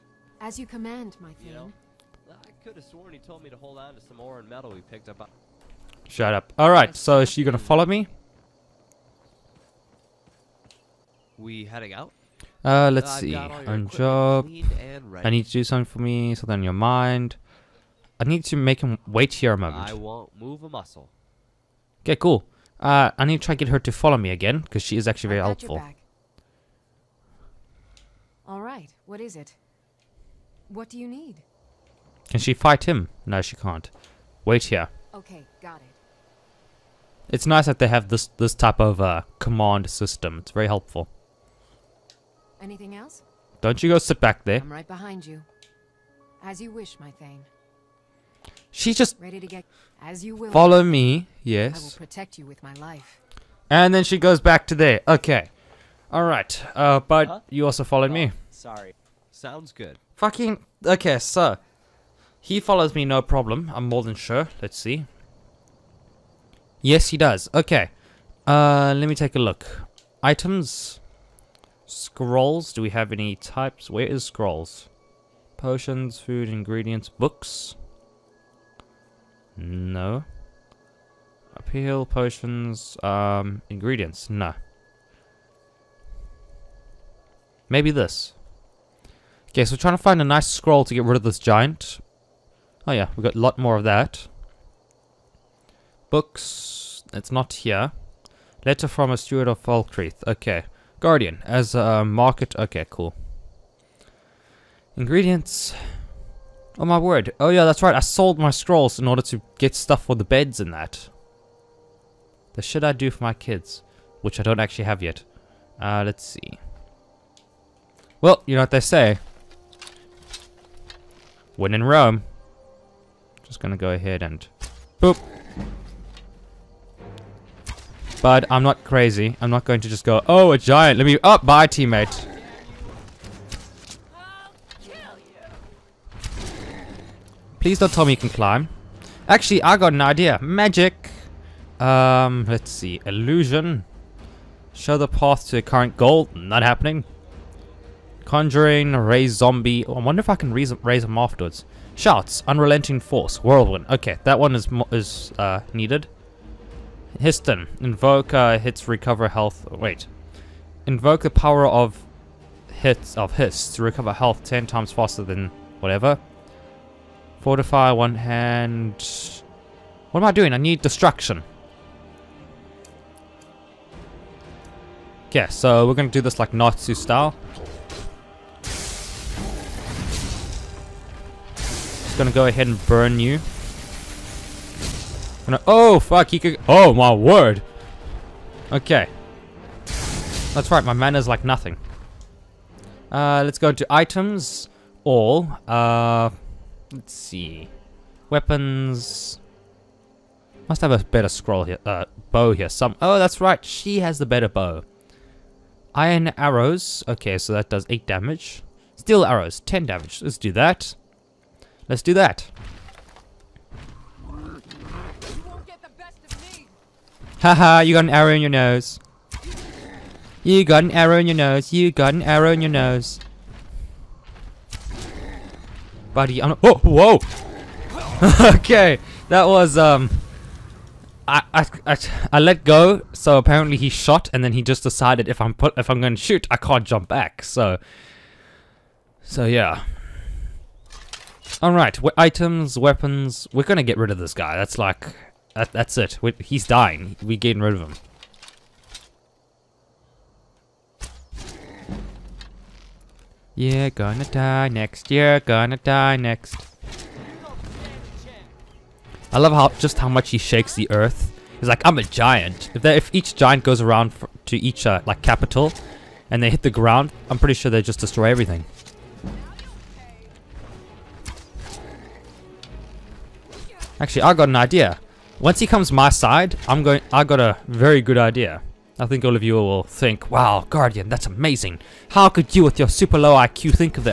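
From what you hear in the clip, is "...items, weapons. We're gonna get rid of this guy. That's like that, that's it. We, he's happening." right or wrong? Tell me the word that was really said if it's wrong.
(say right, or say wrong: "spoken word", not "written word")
wrong: "dying", not "happening".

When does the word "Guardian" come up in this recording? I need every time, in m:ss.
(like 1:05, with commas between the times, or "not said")
1:40, 4:40.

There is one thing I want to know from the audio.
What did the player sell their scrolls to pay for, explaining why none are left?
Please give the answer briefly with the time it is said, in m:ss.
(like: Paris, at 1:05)
beds, at 1:50.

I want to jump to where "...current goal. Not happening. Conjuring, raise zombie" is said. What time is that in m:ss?
2:25.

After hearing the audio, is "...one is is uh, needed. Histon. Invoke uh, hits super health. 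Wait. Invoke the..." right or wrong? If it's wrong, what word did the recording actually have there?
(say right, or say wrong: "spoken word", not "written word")
wrong: "recover", not "super".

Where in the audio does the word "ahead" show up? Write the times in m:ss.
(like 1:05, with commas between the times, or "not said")
2:03, 3:02.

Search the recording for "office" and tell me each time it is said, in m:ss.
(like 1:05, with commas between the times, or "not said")
not said.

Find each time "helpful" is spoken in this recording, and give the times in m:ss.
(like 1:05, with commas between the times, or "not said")
0:25, 0:40.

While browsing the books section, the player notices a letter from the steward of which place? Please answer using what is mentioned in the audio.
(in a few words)
Falkreath.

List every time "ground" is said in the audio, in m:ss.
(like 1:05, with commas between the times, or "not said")
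4:26.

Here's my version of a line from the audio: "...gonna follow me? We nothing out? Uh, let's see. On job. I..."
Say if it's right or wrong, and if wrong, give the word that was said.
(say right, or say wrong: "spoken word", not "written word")
wrong: "heading", not "nothing".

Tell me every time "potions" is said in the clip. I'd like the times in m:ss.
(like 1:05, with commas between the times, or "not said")
1:15, 1:22.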